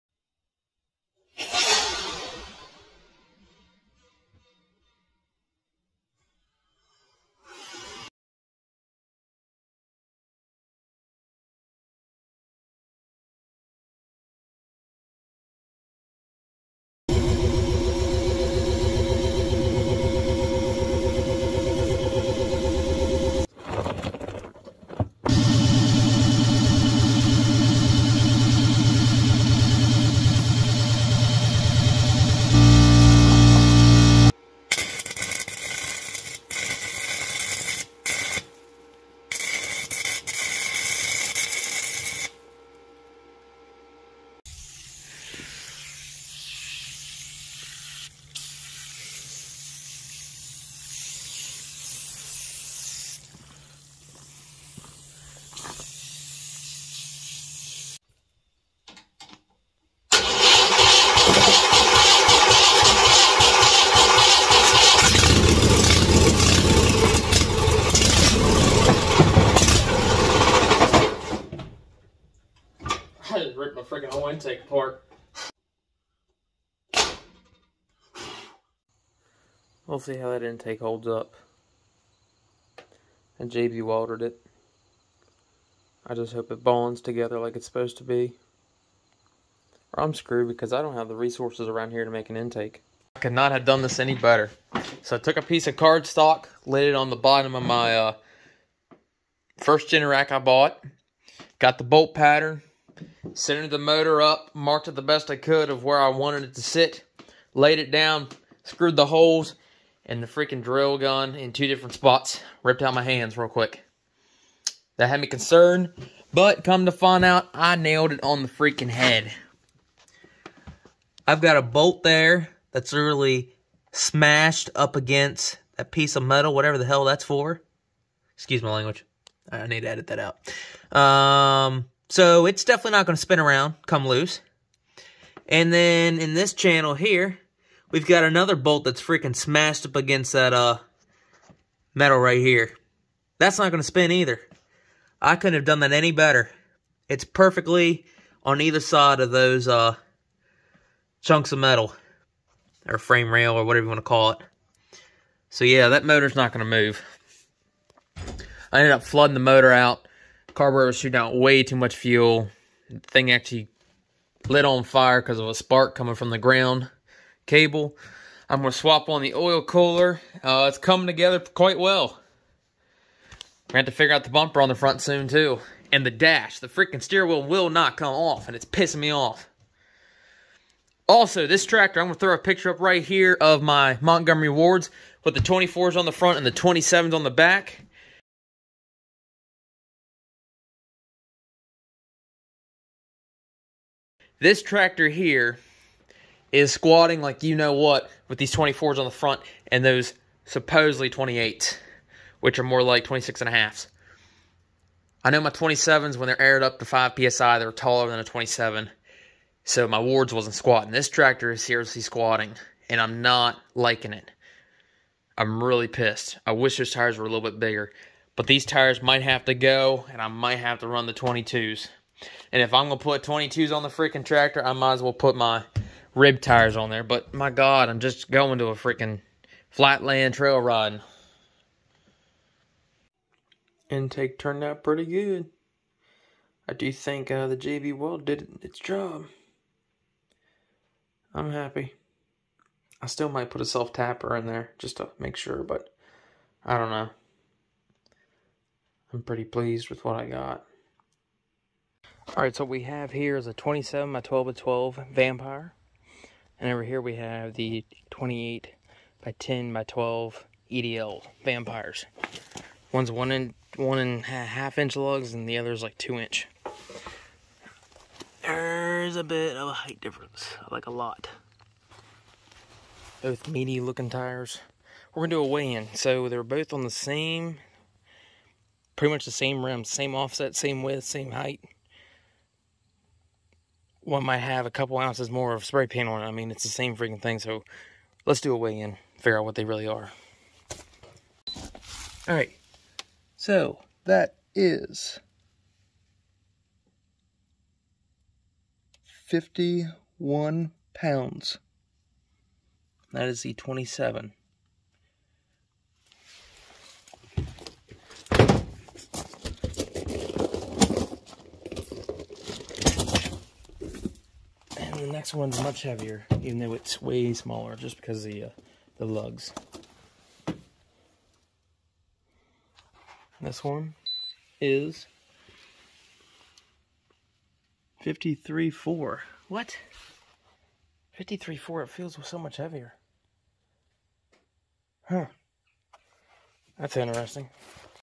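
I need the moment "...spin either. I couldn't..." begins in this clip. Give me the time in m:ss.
2:23.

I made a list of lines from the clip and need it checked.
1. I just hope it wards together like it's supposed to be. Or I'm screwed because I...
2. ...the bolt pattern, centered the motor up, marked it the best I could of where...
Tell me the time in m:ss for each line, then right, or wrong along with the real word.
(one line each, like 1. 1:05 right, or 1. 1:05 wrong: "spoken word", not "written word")
1. 1:26 wrong: "bonds", not "wards"
2. 1:41 right.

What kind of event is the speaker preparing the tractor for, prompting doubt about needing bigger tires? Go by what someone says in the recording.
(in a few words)
flatland trail ride.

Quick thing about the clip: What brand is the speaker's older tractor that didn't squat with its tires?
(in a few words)
Montgomery Wards.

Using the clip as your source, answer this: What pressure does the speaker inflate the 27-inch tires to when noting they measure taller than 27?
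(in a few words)
5 psi.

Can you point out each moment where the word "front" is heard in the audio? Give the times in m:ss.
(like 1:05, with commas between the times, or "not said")
2:54, 3:06, 3:19.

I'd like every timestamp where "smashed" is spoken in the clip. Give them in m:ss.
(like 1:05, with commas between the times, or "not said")
2:03, 2:19.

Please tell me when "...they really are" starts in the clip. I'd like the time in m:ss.
4:49.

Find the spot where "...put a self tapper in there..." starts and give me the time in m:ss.
4:03.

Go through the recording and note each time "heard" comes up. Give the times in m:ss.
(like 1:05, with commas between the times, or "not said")
not said.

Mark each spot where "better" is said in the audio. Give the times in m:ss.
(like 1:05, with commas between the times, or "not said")
1:34, 2:26.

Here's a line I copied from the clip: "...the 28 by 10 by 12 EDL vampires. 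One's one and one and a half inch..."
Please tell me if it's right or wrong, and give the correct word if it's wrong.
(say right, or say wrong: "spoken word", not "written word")
right.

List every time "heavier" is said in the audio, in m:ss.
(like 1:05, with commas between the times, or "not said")
5:15, 5:32.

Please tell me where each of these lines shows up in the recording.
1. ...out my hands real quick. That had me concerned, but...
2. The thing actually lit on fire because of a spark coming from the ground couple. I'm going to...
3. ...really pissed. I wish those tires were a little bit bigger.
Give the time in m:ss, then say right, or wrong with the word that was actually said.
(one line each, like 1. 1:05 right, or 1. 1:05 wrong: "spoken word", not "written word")
1. 1:52 right
2. 2:42 wrong: "cable", not "couple"
3. 3:35 right.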